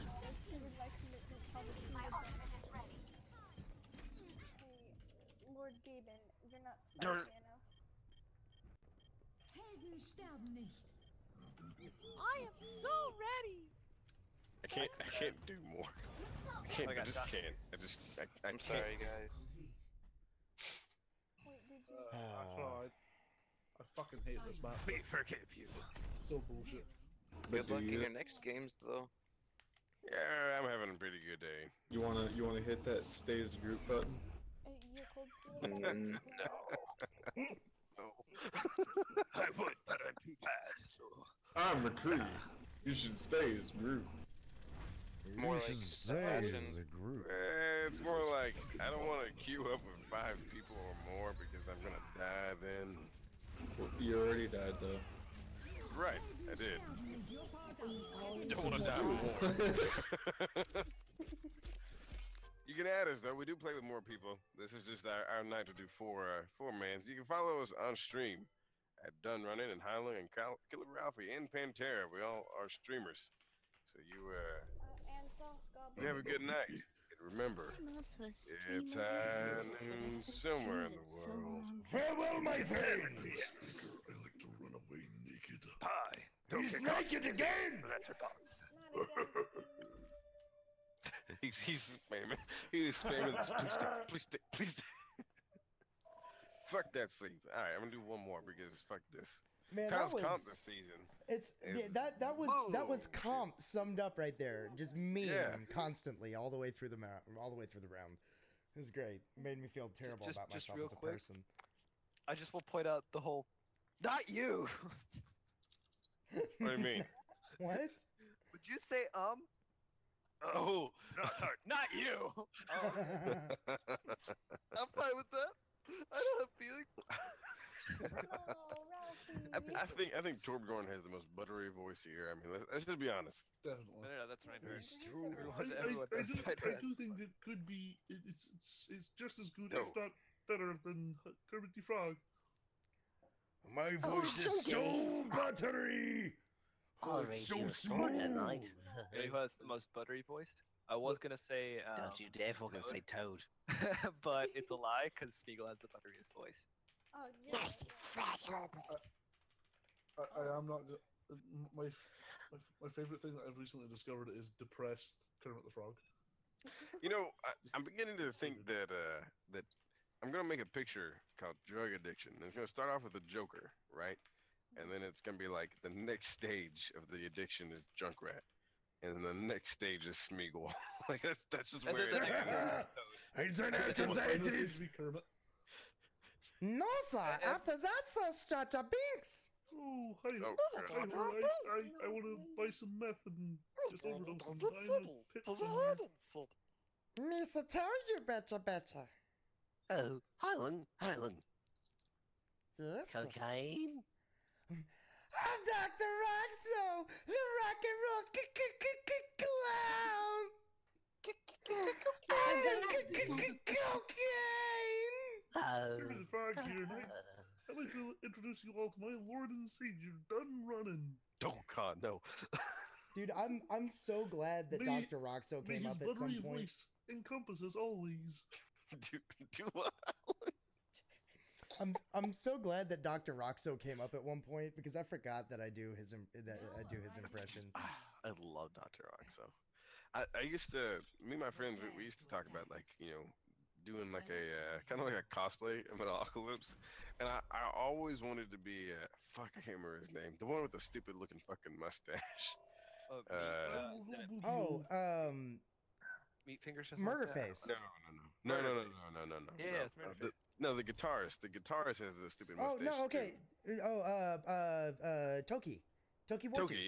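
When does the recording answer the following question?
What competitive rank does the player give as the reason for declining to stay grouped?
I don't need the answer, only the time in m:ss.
0:41.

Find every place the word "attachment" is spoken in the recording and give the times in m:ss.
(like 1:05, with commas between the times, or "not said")
not said.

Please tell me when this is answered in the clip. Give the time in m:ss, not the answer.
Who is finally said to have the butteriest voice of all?
2:35.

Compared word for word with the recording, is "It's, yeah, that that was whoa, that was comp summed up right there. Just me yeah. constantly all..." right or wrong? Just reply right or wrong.
right.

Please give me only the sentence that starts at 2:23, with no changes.
My oh, voice oh, is so buttery.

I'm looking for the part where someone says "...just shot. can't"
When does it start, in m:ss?
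0:17.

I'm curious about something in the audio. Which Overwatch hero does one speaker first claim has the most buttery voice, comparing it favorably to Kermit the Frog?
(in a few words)
Torbjorn.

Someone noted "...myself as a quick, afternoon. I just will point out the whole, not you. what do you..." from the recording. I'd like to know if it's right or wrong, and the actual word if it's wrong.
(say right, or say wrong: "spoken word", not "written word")
wrong: "person", not "afternoon".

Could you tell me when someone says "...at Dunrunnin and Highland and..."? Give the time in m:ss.
1:09.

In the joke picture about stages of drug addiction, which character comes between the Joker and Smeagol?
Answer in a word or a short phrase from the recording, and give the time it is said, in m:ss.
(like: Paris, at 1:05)
Junkrat, at 2:57.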